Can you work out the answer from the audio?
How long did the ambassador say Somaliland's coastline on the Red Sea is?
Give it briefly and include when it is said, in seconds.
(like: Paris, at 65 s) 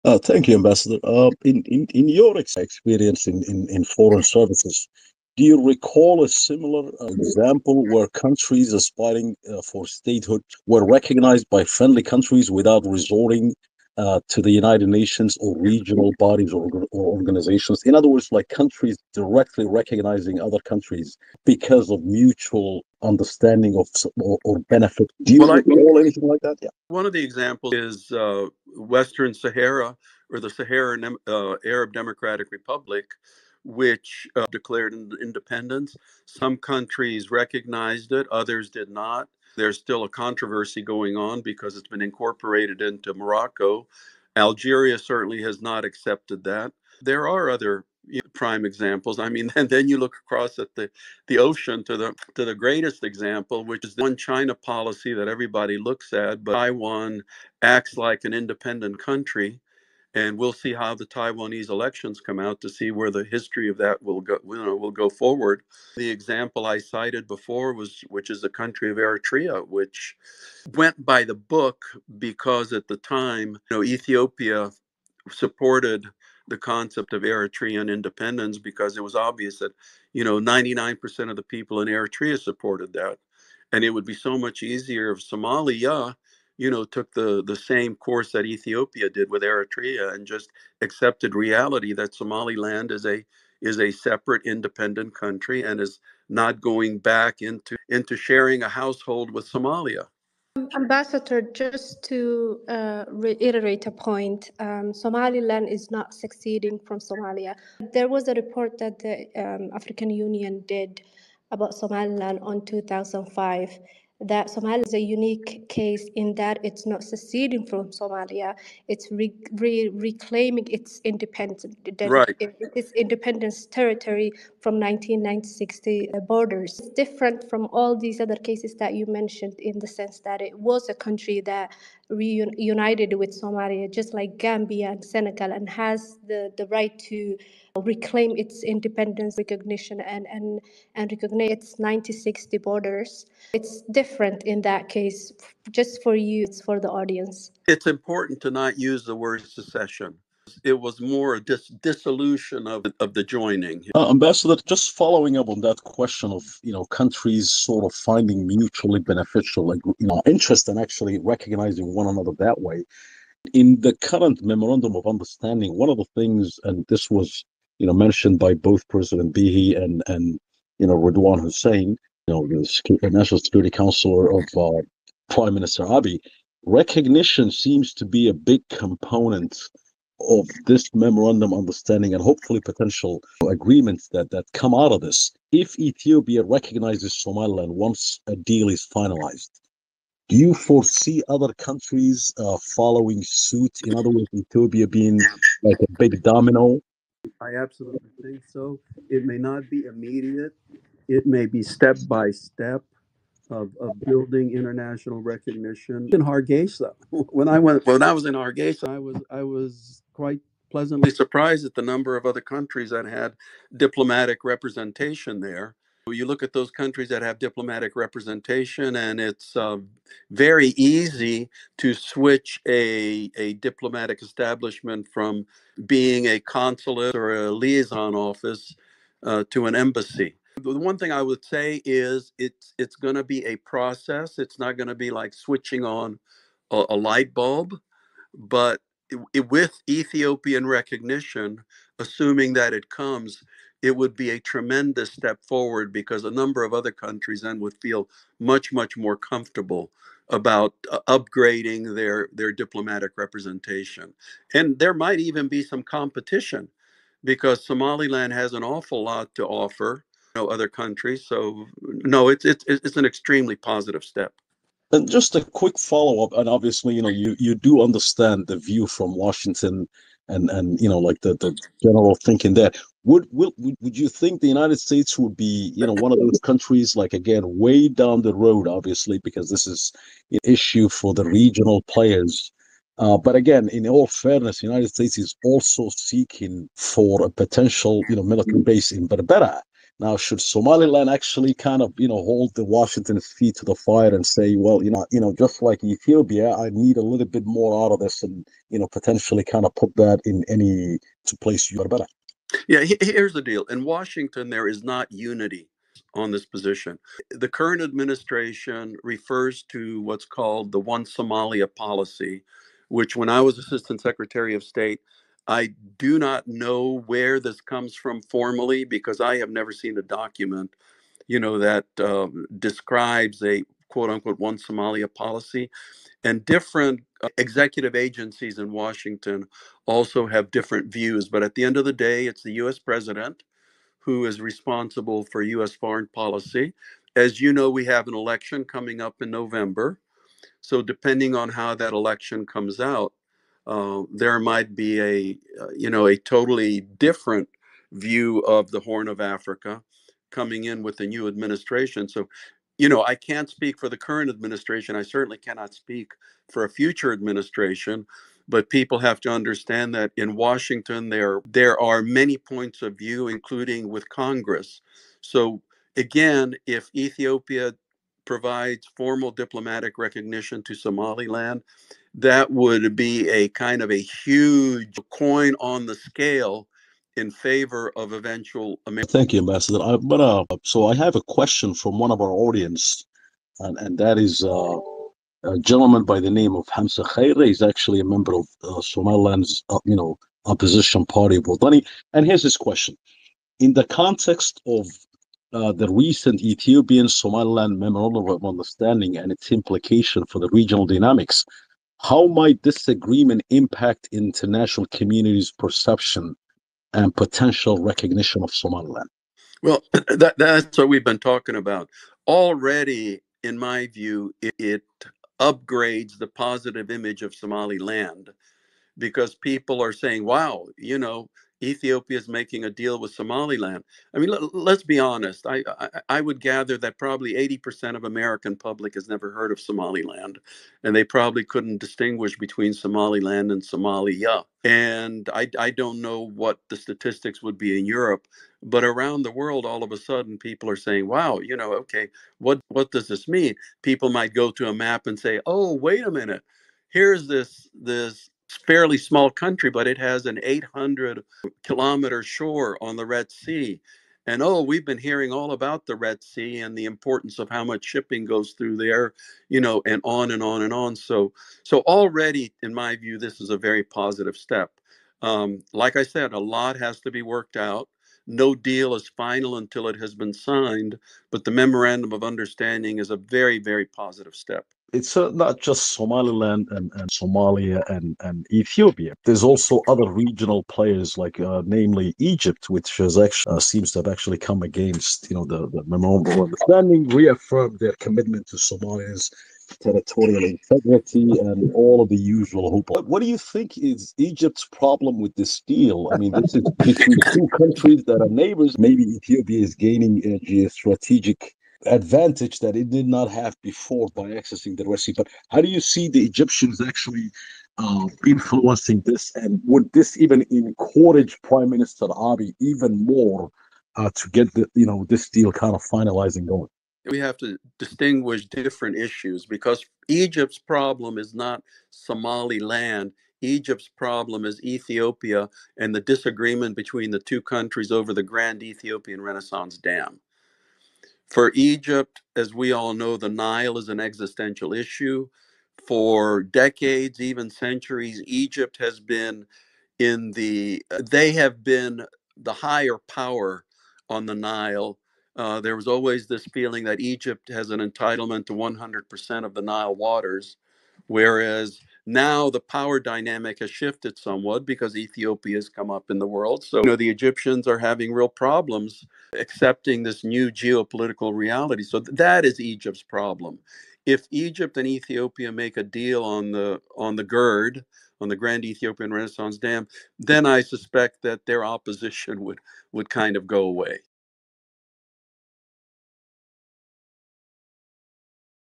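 800 kilometers, at 450 s.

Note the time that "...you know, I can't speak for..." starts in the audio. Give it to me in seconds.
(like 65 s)
352 s.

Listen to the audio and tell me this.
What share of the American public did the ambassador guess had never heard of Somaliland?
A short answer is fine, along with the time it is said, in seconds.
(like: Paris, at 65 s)
80%, at 427 s.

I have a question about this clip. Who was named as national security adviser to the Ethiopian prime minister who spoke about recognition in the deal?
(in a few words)
Radwan Hussein.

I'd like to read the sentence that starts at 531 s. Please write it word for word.
For Egypt, as we all know, the Nile is an existential issue.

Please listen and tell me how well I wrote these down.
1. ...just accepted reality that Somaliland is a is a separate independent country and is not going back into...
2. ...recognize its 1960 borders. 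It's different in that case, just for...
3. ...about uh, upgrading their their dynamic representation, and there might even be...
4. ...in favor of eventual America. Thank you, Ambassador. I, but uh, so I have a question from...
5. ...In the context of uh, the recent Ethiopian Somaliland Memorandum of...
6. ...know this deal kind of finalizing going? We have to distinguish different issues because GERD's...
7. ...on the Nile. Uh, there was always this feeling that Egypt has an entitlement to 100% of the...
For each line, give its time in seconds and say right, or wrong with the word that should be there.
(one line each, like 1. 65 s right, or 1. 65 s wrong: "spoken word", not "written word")
1. 90 s right
2. 141 s right
3. 250 s wrong: "diplomatic", not "dynamic"
4. 377 s right
5. 393 s right
6. 514 s wrong: "Egypt", not "GERD"
7. 544 s right.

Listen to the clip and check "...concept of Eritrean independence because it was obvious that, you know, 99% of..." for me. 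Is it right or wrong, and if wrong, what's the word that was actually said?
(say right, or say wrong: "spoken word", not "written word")
right.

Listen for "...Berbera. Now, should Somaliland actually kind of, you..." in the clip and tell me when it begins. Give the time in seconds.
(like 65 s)
289 s.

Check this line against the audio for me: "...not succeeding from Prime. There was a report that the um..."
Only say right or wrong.
wrong.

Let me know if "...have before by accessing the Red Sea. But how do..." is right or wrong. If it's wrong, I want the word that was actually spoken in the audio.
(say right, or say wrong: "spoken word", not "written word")
right.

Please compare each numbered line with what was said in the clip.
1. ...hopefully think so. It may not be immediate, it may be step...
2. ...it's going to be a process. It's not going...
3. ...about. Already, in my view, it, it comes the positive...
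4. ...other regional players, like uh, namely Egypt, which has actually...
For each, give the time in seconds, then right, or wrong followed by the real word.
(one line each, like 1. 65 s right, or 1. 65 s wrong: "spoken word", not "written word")
1. 197 s wrong: "absolutely", not "hopefully"
2. 232 s right
3. 411 s wrong: "upgrades", not "comes"
4. 479 s right.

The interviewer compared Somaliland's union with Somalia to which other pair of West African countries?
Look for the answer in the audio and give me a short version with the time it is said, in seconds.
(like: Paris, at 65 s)
Gambia and Senegal, at 134 s.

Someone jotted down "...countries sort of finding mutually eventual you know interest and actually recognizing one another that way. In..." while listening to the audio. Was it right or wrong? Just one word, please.
wrong.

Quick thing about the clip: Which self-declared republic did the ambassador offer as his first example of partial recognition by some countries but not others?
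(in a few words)
Western Sahara.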